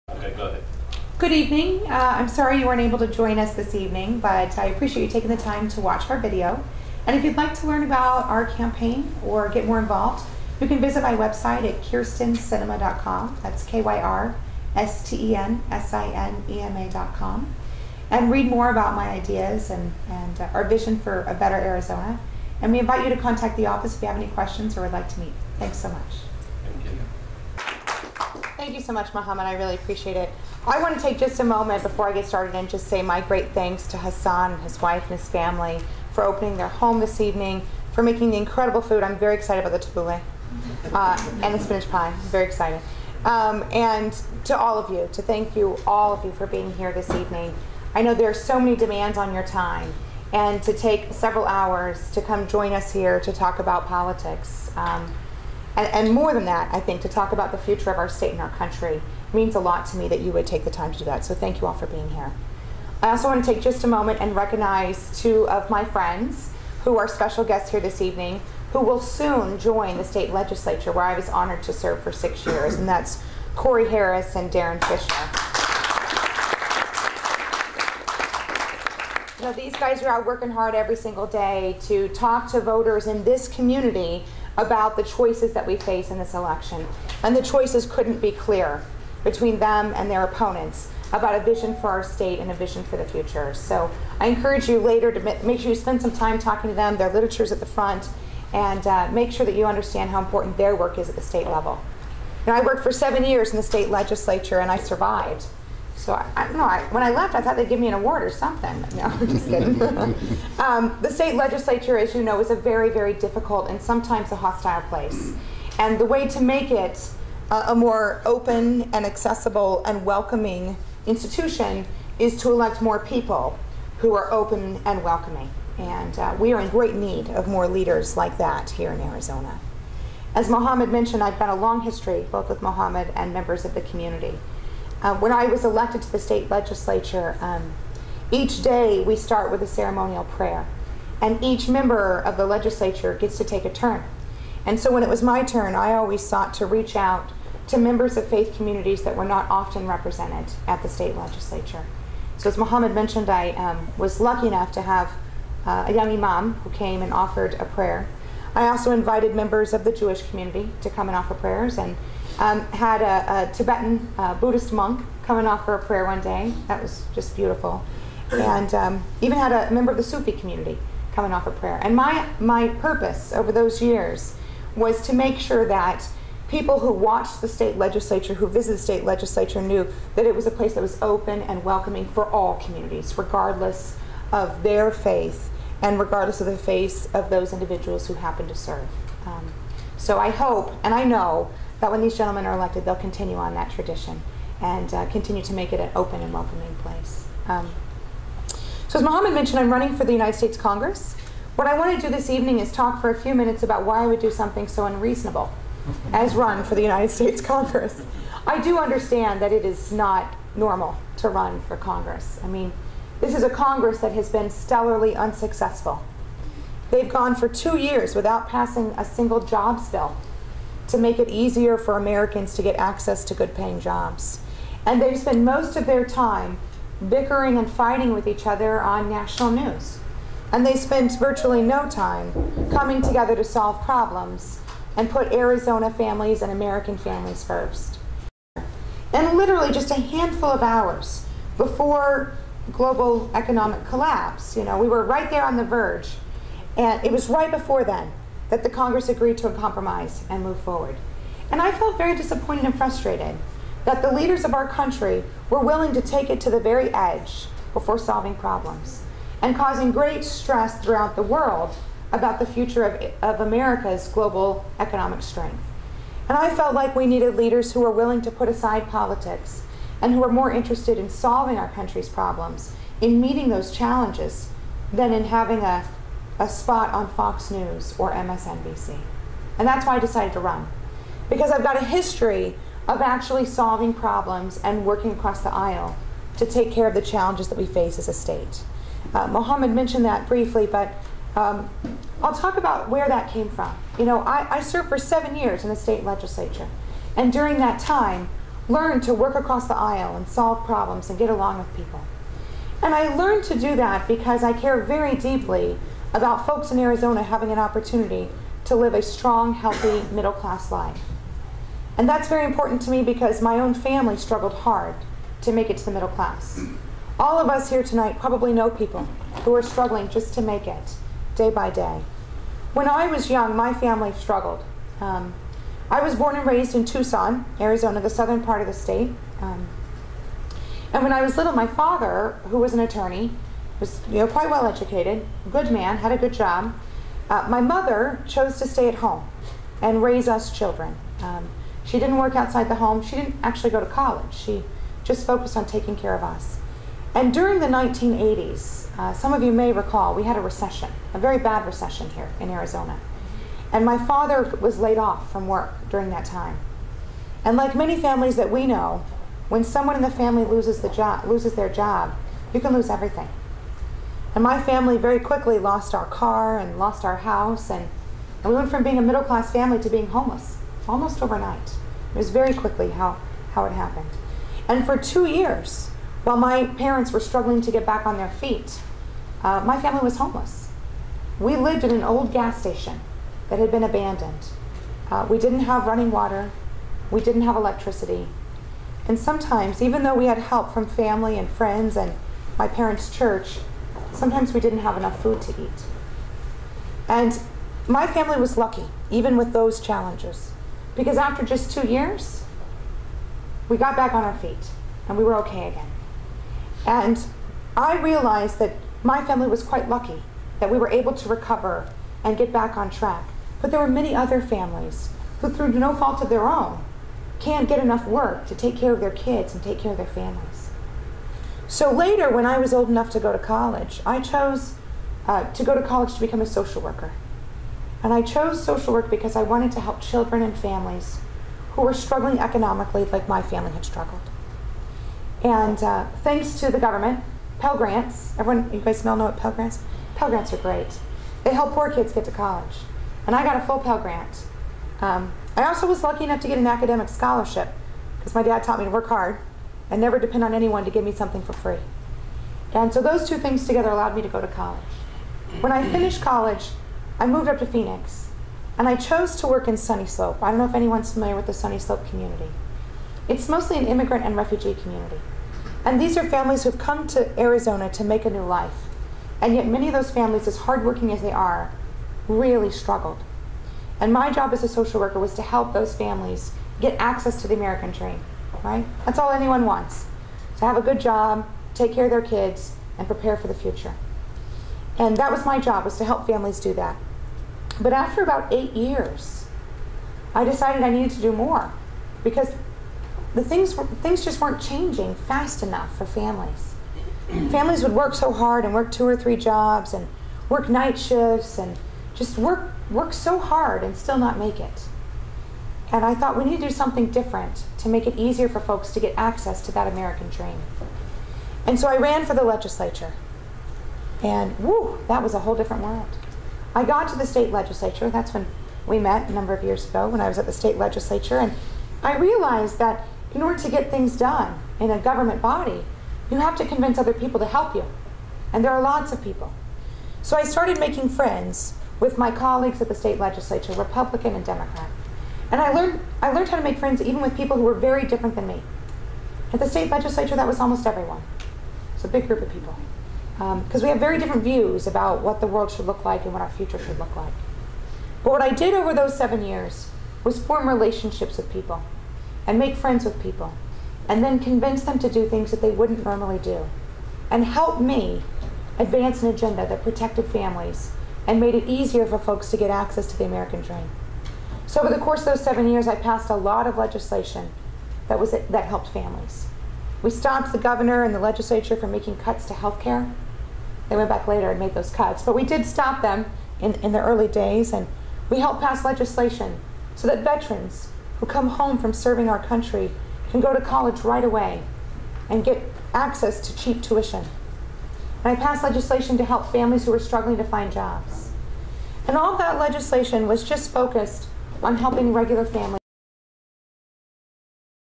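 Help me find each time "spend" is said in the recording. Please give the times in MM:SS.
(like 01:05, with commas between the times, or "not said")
01:35, 03:45, 03:50.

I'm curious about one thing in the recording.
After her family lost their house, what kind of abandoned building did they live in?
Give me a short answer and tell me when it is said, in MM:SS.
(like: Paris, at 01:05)
gas station, at 06:22.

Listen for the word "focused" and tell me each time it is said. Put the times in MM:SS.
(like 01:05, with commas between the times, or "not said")
05:45, 09:53.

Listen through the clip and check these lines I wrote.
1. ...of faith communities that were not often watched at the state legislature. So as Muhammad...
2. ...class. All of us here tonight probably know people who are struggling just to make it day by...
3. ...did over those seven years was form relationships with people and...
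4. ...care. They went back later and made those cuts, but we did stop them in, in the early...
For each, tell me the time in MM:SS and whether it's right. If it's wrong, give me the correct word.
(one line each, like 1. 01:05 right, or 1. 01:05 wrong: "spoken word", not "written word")
1. 02:28 wrong: "represented", not "watched"
2. 05:16 right
3. 09:08 right
4. 09:32 right.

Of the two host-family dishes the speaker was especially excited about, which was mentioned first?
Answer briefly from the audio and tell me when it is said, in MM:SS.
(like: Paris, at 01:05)
tabbouleh, at 00:39.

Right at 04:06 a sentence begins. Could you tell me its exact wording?
And it was right before then that the Congress agreed to a compromise and move forward.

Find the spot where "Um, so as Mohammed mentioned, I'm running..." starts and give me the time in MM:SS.
03:17.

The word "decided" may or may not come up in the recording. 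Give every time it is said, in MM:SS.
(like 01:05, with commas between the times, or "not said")
04:39, 08:10.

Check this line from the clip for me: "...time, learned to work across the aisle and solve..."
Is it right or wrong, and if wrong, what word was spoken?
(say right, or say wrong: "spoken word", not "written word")
right.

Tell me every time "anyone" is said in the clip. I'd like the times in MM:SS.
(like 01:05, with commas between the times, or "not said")
07:30, 07:40, 07:59.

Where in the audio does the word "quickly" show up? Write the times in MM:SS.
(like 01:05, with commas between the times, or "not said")
06:05, 06:12.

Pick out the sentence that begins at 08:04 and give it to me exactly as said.
And that was my job, was to help families do that.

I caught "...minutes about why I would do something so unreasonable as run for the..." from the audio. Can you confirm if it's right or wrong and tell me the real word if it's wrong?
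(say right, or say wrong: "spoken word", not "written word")
right.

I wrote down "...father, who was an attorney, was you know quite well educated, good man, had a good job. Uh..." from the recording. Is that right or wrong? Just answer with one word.
right.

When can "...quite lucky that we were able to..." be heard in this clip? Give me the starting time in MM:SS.
06:49.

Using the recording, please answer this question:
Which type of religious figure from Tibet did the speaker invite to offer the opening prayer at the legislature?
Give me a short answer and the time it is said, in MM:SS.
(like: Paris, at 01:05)
Buddhist monk, at 02:44.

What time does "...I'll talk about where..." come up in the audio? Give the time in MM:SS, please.
04:52.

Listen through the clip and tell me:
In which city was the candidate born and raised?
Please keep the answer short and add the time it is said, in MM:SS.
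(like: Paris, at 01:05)
Tucson, at 05:26.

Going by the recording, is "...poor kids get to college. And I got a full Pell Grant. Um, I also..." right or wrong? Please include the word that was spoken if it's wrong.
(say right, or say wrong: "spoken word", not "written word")
right.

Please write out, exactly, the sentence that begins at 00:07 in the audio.
And if you'd like to learn about our campaign or get more involved, you can visit my website at kyrstensinema.com.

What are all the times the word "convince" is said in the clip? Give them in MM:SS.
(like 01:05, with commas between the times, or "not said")
08:46, 09:14.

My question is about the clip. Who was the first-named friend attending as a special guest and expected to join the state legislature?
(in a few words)
Corey Harris.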